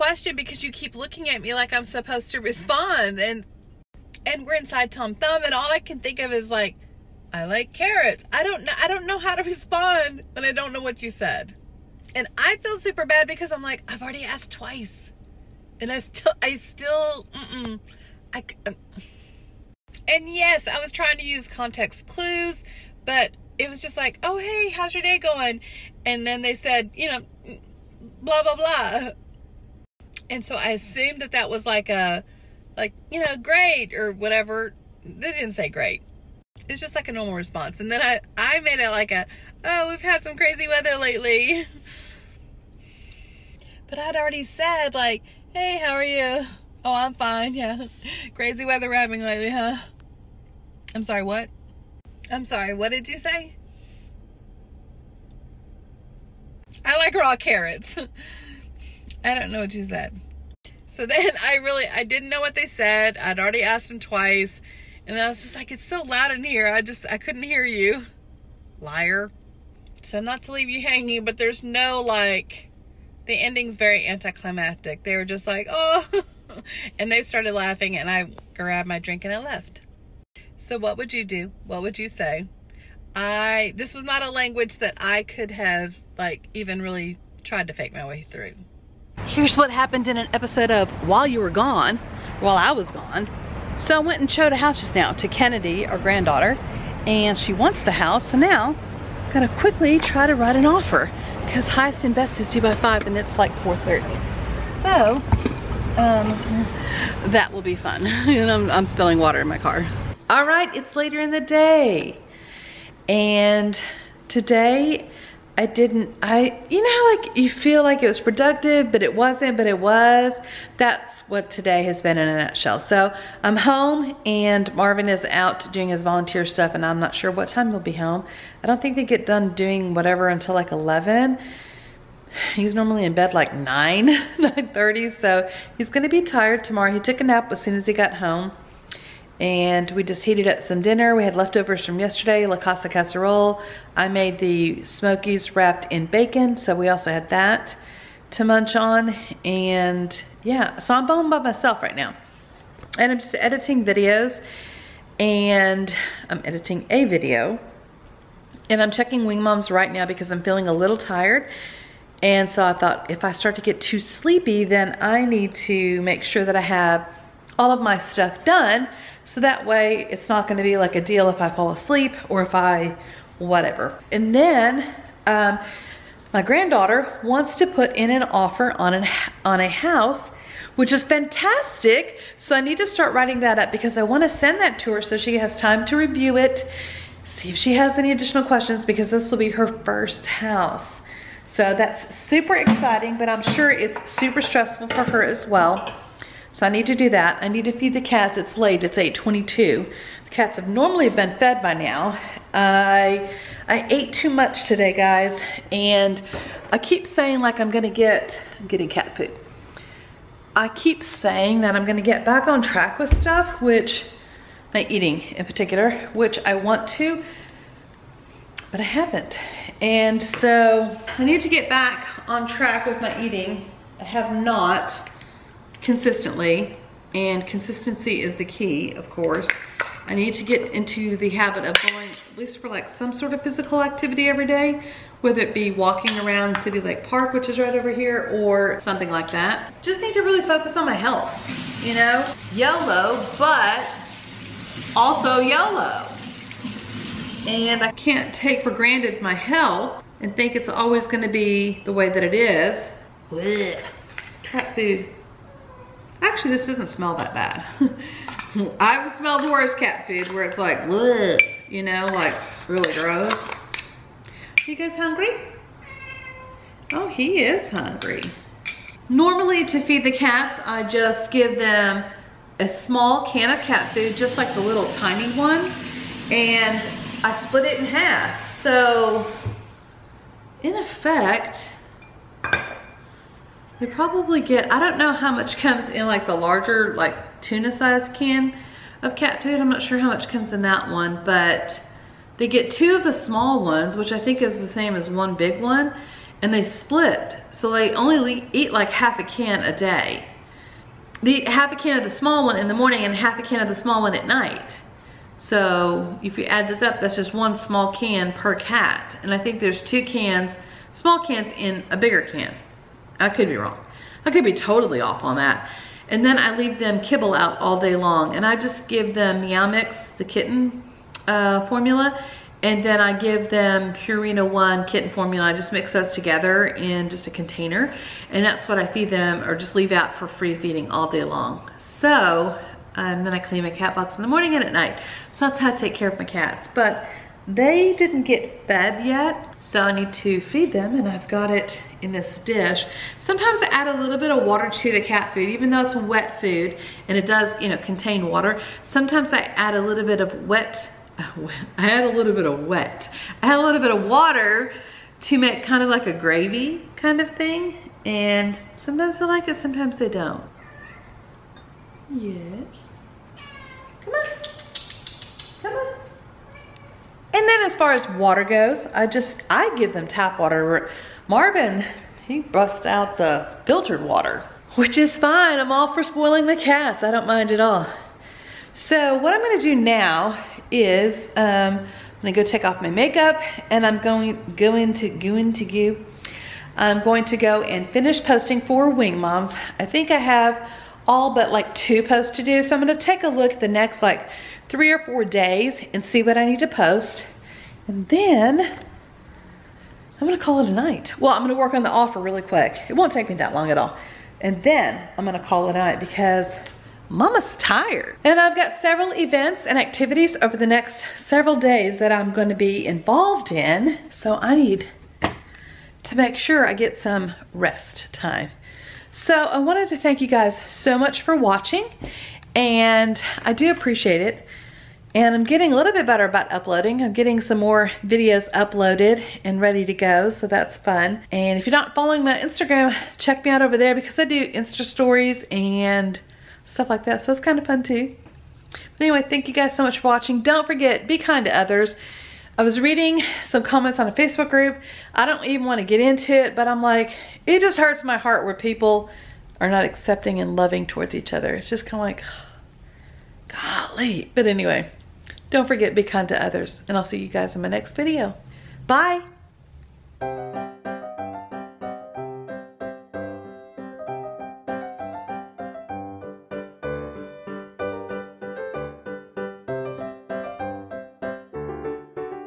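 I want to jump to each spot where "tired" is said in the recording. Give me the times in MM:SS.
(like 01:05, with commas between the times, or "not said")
02:16, 02:40, 06:47.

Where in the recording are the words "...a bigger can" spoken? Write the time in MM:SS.
05:11.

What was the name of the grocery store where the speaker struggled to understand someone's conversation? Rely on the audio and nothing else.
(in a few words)
Tom Thumb.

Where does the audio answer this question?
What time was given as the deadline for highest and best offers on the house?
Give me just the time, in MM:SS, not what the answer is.
01:43.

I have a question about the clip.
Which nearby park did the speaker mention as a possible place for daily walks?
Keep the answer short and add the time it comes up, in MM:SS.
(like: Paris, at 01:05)
City Lake Park, at 03:56.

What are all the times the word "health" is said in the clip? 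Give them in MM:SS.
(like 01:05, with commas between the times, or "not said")
04:00, 04:09.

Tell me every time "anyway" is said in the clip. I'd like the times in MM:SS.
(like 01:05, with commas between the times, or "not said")
07:19, 07:34.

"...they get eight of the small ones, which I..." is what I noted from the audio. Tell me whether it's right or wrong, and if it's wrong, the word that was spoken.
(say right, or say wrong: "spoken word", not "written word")
wrong: "two", not "eight".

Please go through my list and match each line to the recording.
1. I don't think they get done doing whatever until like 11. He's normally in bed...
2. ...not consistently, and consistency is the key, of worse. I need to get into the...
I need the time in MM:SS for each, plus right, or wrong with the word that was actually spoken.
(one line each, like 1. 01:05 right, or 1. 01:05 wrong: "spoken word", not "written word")
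1. 02:08 right
2. 03:44 wrong: "course", not "worse".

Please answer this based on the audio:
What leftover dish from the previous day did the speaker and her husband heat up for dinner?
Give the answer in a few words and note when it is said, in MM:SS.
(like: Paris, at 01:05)
La Casa casserole, at 02:22.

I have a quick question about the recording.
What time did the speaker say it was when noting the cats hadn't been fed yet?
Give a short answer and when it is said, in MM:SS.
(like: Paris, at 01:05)
8:22, at 03:18.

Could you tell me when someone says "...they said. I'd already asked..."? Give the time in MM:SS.
01:02.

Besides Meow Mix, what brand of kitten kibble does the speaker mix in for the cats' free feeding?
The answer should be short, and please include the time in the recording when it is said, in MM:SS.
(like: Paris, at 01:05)
Purina 1, at 05:23.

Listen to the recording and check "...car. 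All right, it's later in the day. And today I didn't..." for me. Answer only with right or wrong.
right.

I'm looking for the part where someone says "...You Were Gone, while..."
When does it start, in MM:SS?
01:31.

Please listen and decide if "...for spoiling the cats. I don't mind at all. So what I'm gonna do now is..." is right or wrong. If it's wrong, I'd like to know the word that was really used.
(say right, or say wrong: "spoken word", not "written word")
right.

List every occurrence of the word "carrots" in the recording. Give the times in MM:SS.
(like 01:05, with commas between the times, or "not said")
00:07, 00:57.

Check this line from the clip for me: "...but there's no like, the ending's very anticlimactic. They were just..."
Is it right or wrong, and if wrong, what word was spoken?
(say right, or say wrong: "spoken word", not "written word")
right.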